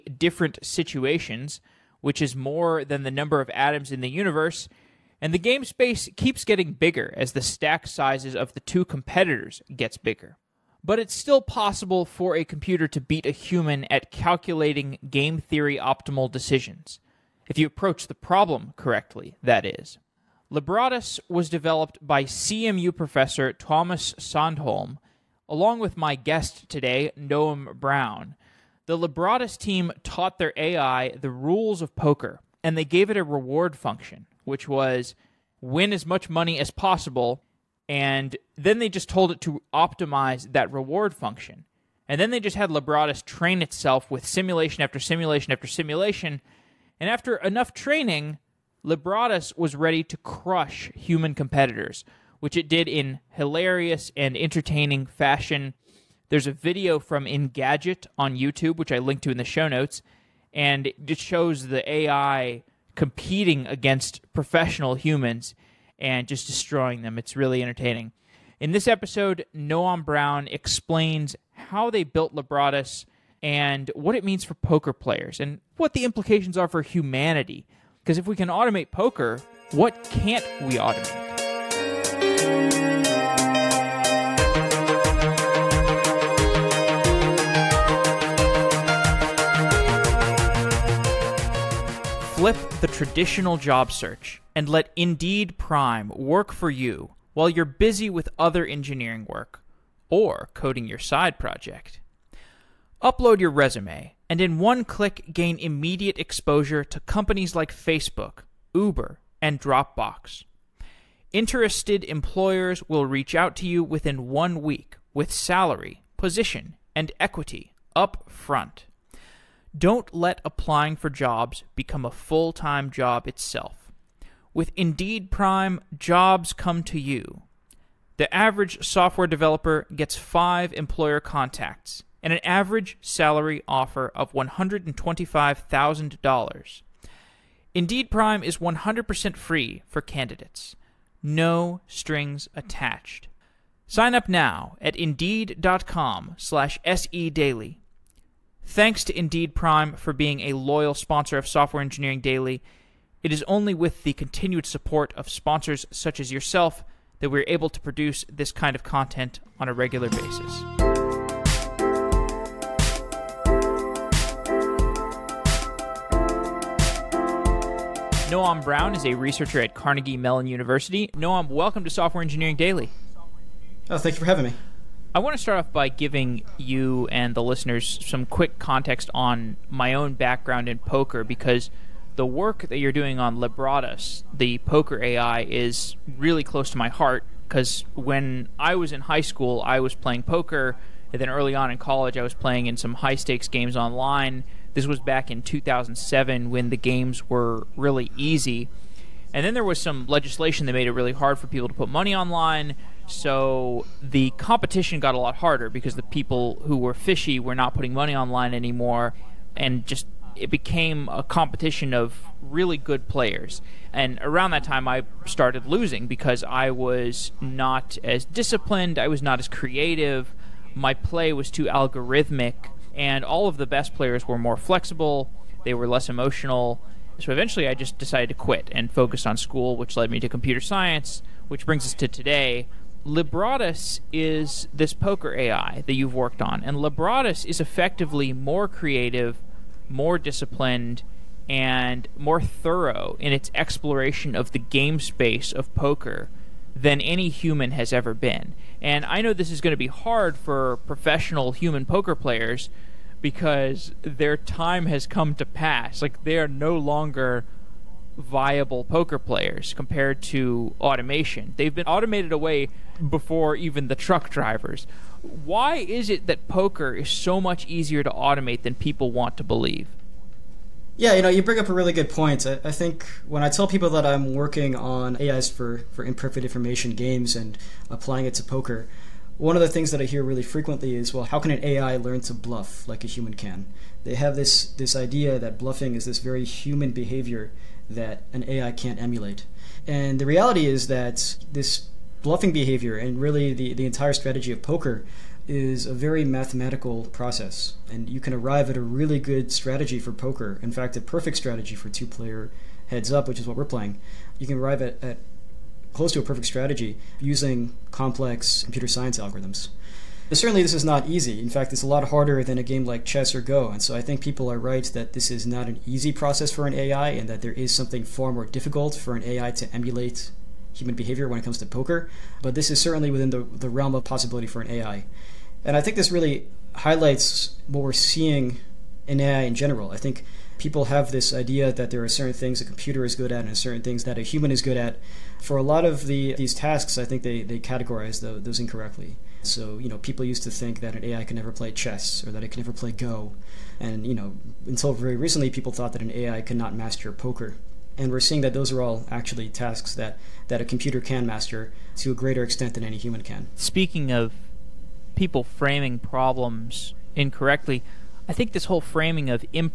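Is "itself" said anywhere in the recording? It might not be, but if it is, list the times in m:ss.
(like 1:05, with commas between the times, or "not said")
0:43, 2:03.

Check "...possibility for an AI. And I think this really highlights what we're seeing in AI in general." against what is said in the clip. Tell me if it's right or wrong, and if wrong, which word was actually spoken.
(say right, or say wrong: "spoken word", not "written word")
right.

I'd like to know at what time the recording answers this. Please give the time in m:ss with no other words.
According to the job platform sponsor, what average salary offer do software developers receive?
2:14.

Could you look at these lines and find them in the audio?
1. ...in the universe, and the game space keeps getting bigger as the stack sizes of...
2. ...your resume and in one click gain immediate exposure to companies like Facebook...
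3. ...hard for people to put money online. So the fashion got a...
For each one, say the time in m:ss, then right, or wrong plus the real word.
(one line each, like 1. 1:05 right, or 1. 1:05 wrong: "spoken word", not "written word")
1. 0:03 right
2. 1:43 right
3. 3:21 wrong: "competition", not "fashion".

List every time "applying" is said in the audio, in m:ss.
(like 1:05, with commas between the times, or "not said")
2:00, 4:37.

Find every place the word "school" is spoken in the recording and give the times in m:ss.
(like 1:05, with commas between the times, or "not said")
3:09, 3:49.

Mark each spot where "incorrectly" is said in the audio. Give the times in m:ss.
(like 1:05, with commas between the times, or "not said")
5:38, 5:57.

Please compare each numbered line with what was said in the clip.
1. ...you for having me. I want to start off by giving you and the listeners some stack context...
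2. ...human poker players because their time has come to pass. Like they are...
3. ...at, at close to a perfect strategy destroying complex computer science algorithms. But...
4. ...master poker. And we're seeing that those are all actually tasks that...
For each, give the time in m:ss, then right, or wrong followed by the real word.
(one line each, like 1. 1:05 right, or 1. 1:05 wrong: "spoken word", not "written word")
1. 2:54 wrong: "quick", not "stack"
2. 4:11 right
3. 5:04 wrong: "using", not "destroying"
4. 5:46 right.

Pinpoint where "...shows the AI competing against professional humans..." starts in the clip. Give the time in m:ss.
1:01.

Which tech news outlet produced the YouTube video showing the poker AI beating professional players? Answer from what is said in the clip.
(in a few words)
Engadget.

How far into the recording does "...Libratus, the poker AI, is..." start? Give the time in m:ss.
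3:03.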